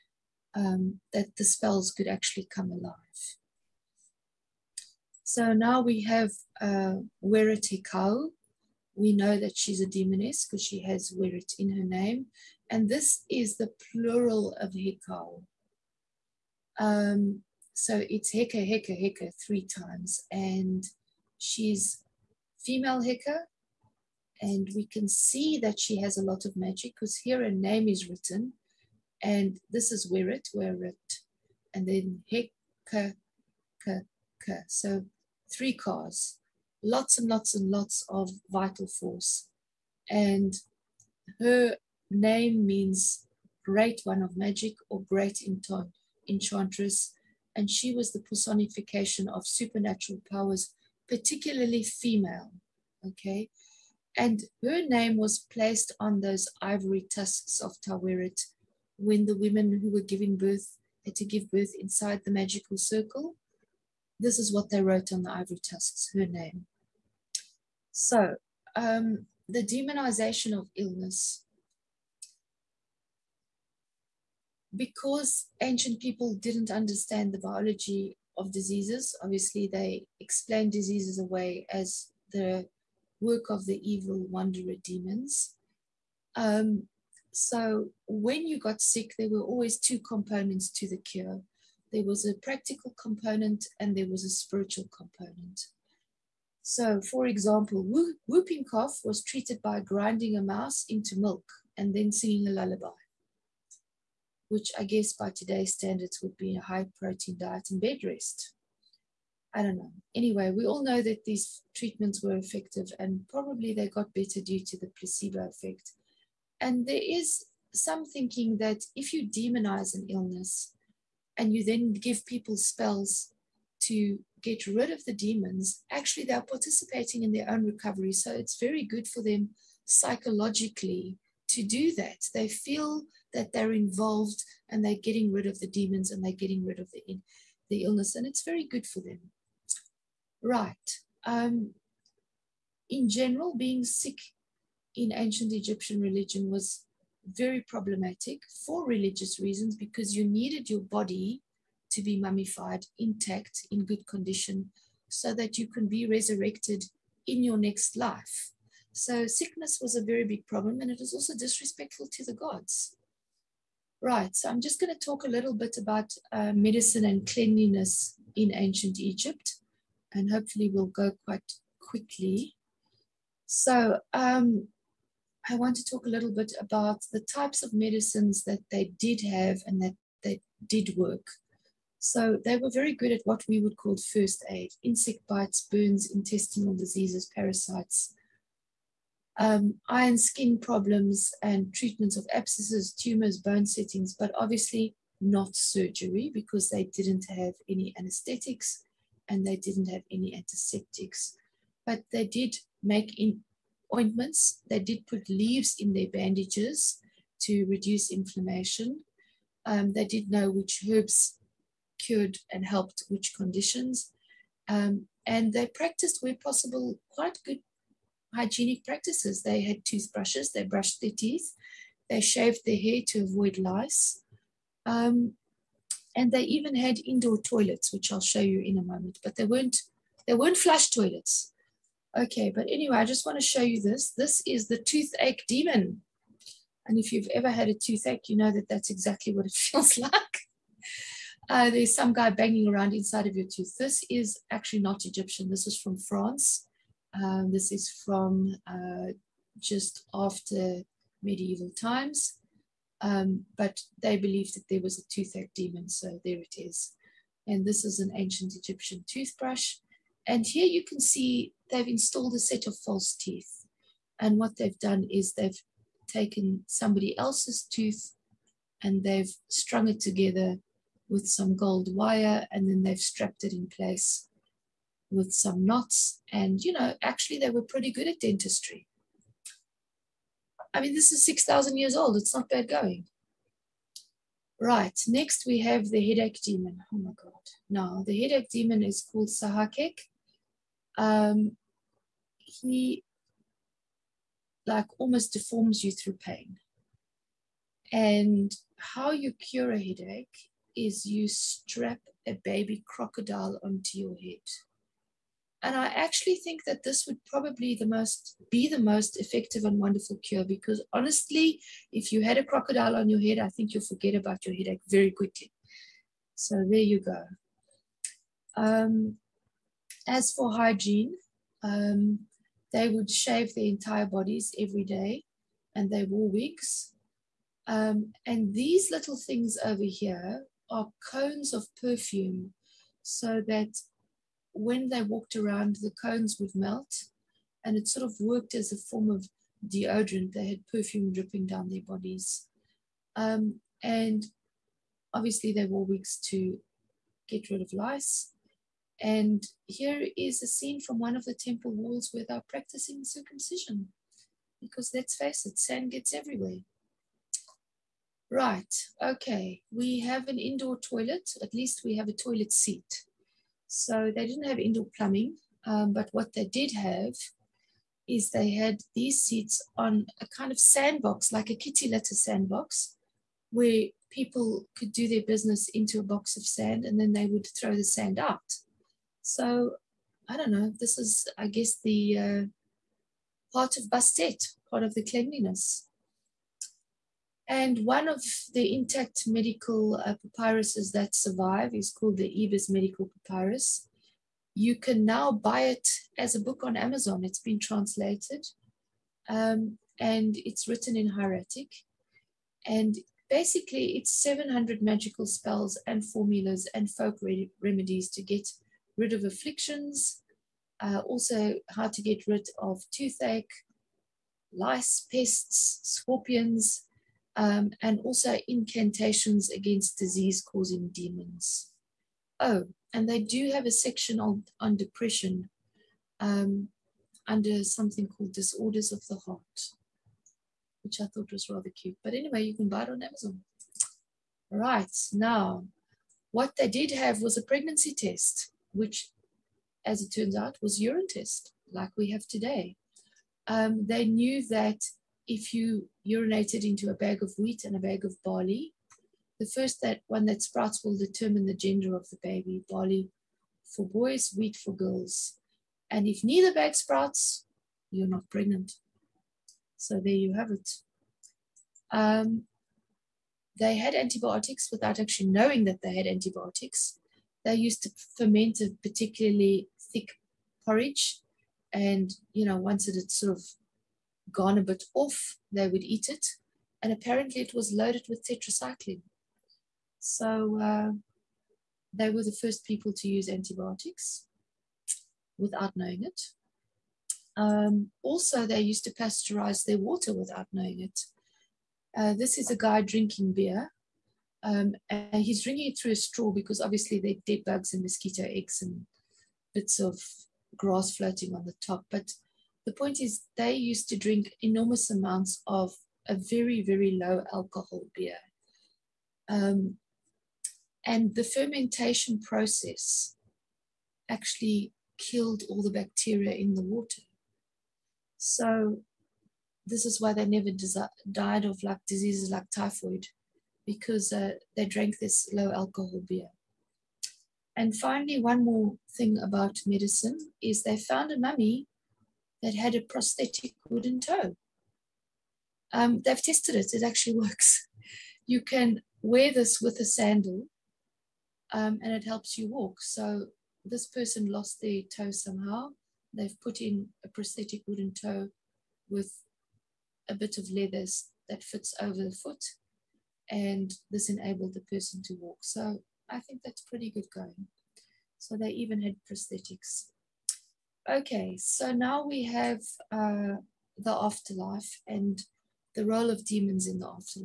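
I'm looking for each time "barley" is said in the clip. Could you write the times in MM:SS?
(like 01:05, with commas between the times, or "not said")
07:28, 07:32.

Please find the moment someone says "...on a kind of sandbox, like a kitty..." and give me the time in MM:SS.
06:09.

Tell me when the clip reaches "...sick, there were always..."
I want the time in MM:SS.
01:28.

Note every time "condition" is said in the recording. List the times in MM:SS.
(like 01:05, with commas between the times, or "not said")
02:34, 03:33.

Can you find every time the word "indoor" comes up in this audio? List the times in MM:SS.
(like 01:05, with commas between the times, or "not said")
03:47, 06:00, 06:04.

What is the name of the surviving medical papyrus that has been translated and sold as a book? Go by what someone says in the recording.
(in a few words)
Ebers Medical Papyrus.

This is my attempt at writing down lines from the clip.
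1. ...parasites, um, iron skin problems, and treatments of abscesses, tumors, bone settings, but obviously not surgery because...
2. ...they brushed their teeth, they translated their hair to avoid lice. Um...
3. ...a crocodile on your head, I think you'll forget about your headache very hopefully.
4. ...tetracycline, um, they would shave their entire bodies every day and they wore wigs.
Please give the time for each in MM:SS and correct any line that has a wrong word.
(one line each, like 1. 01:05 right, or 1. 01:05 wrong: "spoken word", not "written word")
1. 03:07 right
2. 03:40 wrong: "shaved", not "translated"
3. 05:12 wrong: "quickly", not "hopefully"
4. 05:20 wrong: "hygiene", not "tetracycline".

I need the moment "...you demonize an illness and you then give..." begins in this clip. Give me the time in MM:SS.
01:59.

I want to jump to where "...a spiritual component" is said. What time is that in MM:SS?
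01:34.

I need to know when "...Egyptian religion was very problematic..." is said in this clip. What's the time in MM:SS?
02:25.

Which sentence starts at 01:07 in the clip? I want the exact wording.
So, um, the demonization of illness.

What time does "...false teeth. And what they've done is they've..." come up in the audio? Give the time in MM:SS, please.
04:22.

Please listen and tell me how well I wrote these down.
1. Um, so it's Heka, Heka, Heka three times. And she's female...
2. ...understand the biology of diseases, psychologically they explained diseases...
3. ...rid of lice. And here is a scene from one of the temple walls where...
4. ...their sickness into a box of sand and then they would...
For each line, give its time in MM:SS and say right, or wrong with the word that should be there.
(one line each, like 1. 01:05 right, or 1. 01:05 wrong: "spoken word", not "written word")
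1. 00:16 right
2. 01:16 wrong: "obviously", not "psychologically"
3. 05:47 right
4. 06:15 wrong: "business", not "sickness".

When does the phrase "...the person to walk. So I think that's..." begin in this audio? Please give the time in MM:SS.
09:14.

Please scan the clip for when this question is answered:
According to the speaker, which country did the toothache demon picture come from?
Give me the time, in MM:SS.
04:05.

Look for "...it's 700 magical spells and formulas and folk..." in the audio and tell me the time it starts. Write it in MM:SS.
06:43.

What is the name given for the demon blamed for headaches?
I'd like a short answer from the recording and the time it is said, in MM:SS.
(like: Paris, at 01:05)
Sahakek, at 04:49.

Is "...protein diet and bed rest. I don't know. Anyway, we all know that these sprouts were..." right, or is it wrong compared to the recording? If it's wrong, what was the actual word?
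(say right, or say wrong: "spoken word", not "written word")
wrong: "treatments", not "sprouts".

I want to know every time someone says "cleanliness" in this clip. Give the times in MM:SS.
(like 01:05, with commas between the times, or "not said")
02:47, 06:25.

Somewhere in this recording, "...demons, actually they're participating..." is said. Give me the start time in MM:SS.
02:05.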